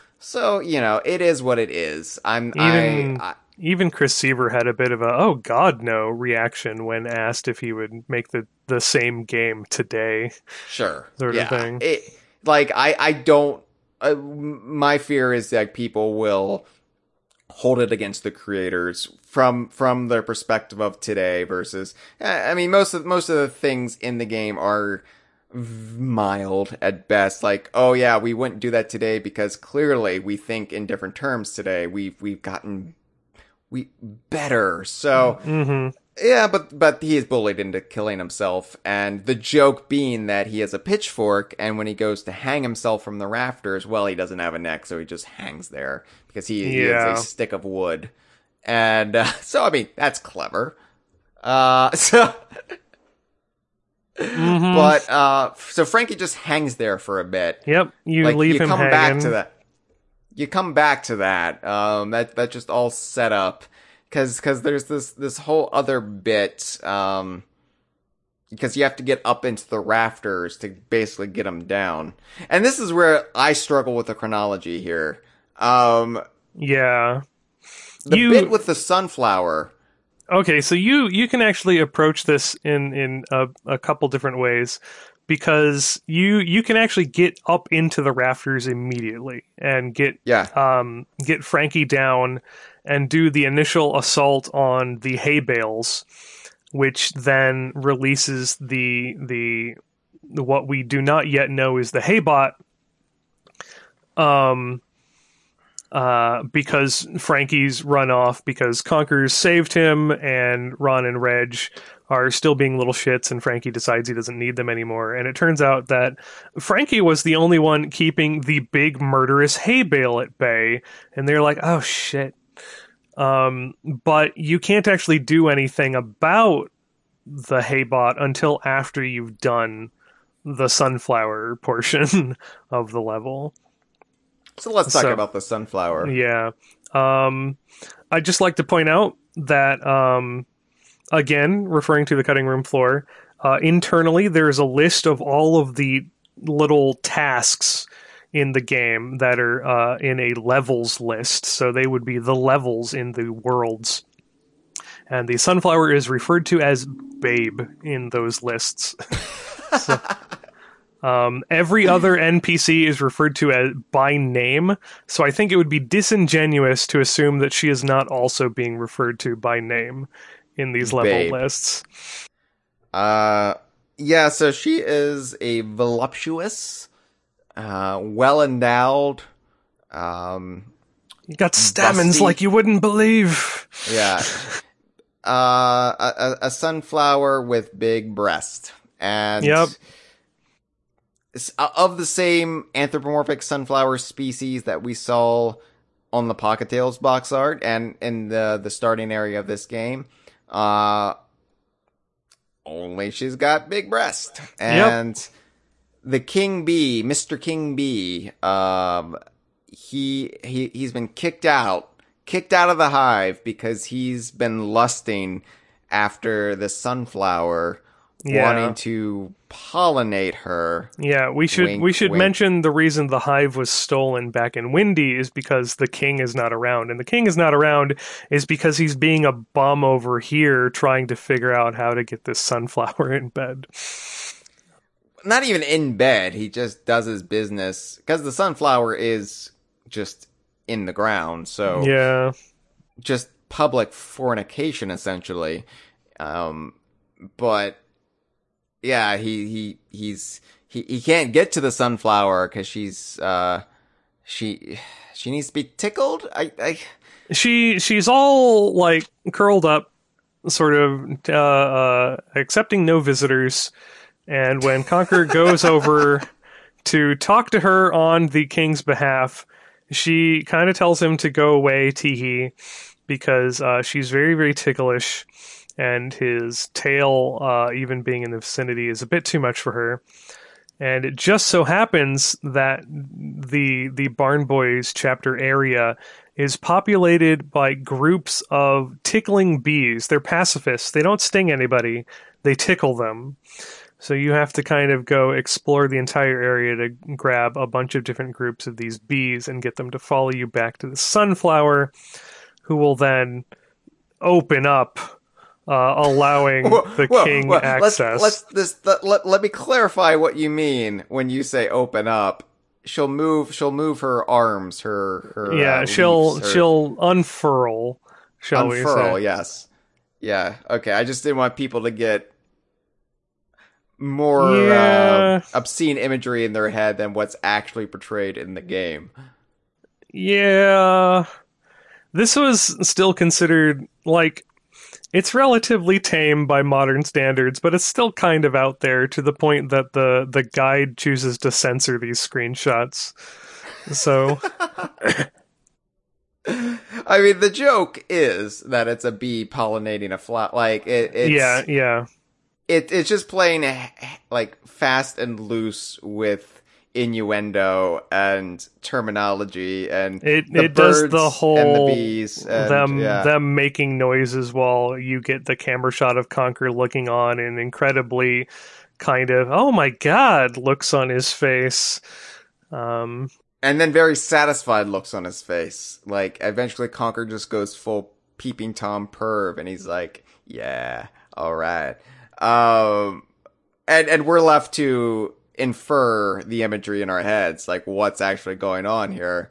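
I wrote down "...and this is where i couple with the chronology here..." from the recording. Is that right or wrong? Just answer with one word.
wrong.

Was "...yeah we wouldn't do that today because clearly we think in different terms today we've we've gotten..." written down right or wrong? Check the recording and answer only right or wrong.
right.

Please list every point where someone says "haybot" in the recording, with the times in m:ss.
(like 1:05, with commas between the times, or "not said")
1:41, 2:07.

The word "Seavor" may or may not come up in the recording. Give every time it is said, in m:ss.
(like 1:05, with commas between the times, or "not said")
0:04.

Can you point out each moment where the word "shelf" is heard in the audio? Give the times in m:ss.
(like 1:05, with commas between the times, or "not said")
not said.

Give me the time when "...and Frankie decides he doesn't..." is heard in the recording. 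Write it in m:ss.
1:53.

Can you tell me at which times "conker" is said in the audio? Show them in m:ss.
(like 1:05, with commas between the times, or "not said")
1:48, 4:24, 6:06, 6:16.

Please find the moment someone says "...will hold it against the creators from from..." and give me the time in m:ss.
0:16.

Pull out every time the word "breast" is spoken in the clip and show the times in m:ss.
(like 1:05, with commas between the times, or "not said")
3:08, 3:23.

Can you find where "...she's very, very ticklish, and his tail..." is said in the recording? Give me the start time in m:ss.
4:33.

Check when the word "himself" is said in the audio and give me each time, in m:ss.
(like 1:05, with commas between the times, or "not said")
0:38, 0:42.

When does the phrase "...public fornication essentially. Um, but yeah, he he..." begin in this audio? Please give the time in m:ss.
4:03.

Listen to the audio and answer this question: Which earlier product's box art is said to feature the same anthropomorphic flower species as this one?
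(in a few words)
Pocket Tales.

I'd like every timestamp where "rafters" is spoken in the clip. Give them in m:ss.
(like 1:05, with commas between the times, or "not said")
0:43, 1:09, 1:28.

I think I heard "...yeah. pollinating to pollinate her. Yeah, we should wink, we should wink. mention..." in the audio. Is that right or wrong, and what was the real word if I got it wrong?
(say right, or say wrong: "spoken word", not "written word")
wrong: "wanting", not "pollinating".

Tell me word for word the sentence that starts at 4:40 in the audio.
And it just so happens that the the Barn Boys chapter area is populated by groups of tickling bees.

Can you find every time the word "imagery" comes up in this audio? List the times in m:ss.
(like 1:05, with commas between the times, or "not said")
5:25, 6:26.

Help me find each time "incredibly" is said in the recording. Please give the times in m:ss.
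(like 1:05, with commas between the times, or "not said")
6:07.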